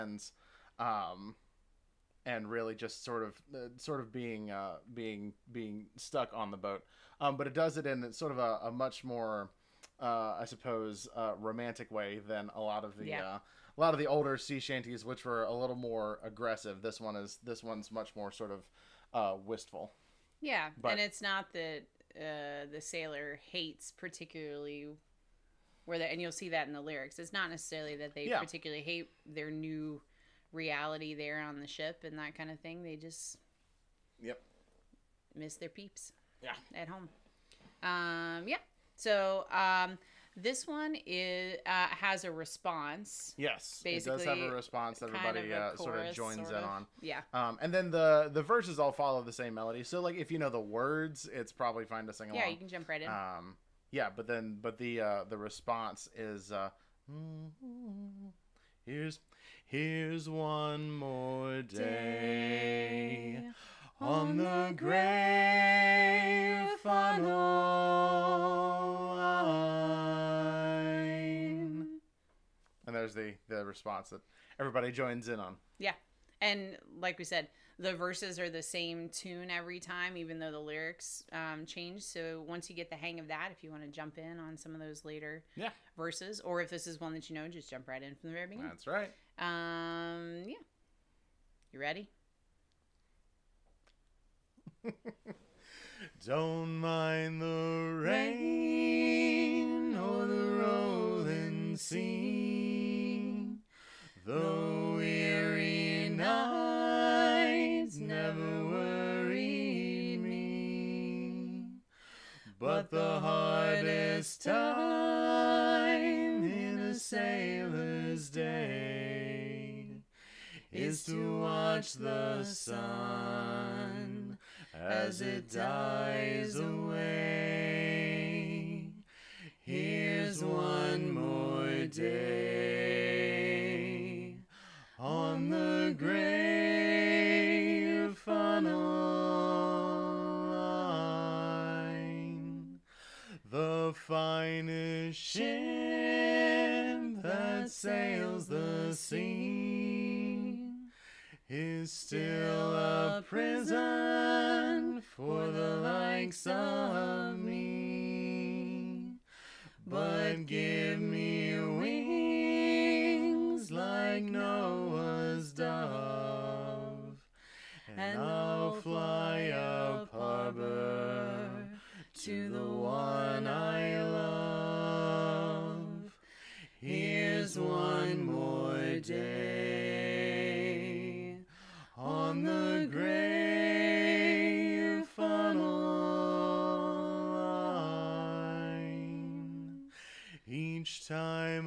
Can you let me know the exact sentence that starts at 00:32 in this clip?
They just yep miss their peeps.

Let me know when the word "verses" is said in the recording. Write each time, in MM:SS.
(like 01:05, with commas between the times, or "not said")
00:48, 01:17, 01:25.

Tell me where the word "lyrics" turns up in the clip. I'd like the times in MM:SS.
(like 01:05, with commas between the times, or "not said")
00:26, 01:20.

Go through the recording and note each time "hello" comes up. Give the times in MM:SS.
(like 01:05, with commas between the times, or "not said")
not said.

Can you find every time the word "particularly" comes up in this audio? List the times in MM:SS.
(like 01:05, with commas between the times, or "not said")
00:23, 00:28.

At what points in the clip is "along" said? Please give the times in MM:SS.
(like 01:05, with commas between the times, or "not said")
00:52.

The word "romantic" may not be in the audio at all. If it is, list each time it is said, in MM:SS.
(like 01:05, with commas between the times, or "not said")
00:11.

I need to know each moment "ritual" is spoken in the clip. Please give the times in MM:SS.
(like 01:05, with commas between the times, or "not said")
not said.